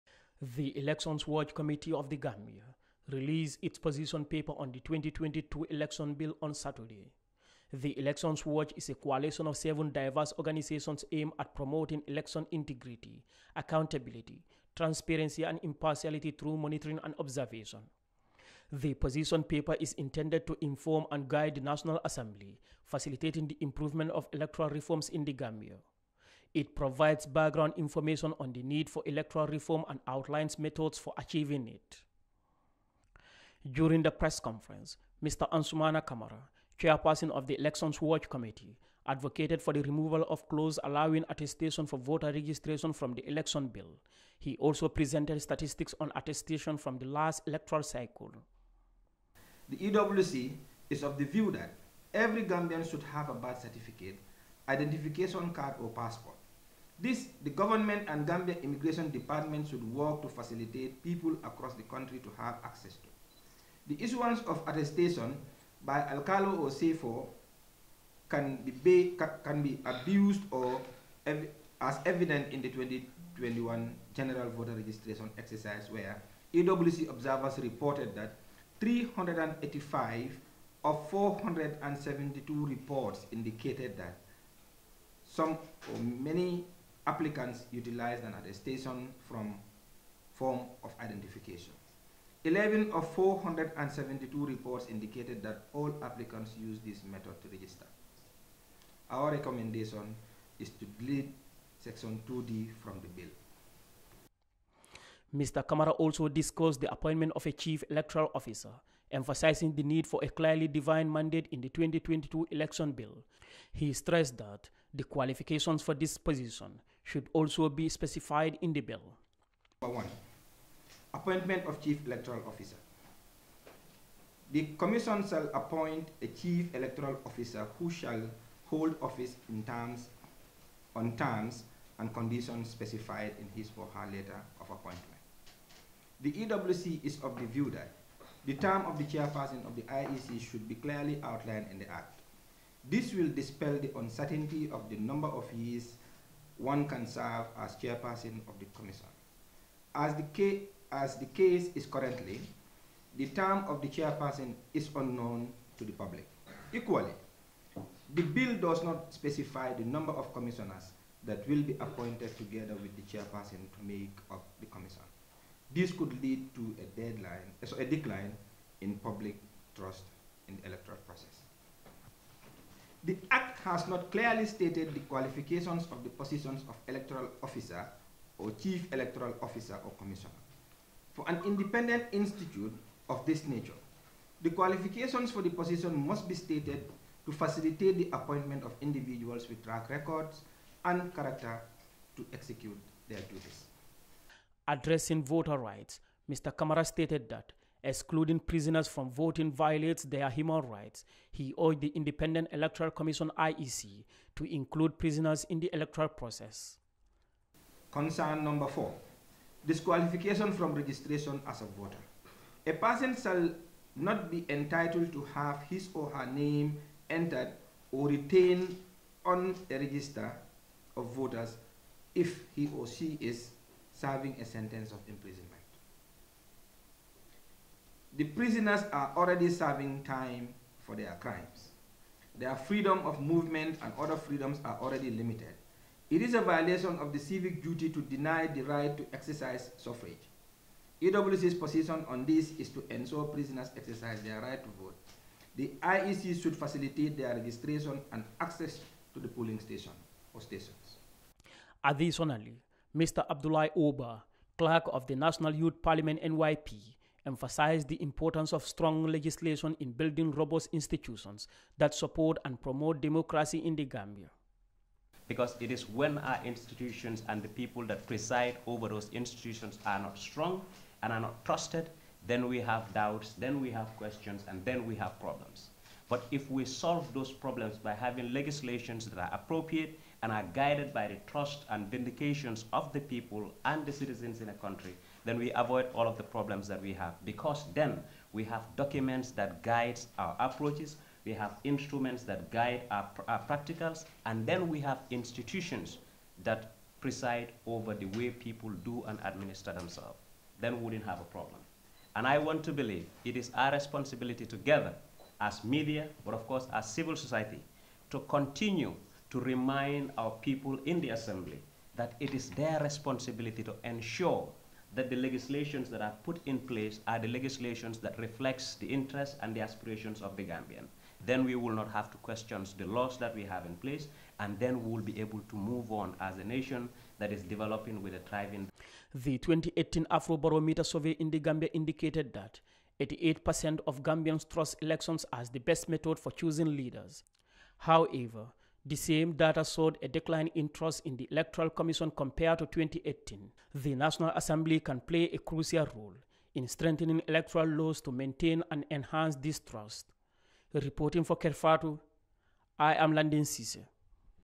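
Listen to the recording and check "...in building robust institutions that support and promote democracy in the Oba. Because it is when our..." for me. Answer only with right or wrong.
wrong.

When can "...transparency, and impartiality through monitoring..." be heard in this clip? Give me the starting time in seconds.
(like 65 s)
14 s.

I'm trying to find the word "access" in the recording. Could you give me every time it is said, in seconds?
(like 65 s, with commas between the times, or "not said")
62 s, 248 s.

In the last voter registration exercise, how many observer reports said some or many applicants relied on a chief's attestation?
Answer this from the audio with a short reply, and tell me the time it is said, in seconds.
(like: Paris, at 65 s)
385, at 78 s.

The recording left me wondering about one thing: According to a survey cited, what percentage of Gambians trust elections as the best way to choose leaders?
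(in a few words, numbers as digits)
88%.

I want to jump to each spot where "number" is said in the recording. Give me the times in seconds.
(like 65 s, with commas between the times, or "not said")
119 s, 144 s, 159 s, 208 s.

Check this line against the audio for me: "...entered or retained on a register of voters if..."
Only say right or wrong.
right.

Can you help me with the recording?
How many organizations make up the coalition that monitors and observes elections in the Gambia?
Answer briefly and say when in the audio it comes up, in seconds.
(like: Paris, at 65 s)
7, at 9 s.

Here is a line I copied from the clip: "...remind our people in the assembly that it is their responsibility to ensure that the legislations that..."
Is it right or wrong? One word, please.
right.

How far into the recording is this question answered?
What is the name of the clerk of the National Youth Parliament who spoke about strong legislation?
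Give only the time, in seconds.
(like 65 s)
253 s.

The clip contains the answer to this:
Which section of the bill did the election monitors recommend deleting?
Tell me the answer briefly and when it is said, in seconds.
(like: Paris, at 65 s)
Section 2D, at 101 s.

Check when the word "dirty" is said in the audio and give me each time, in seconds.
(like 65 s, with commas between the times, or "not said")
not said.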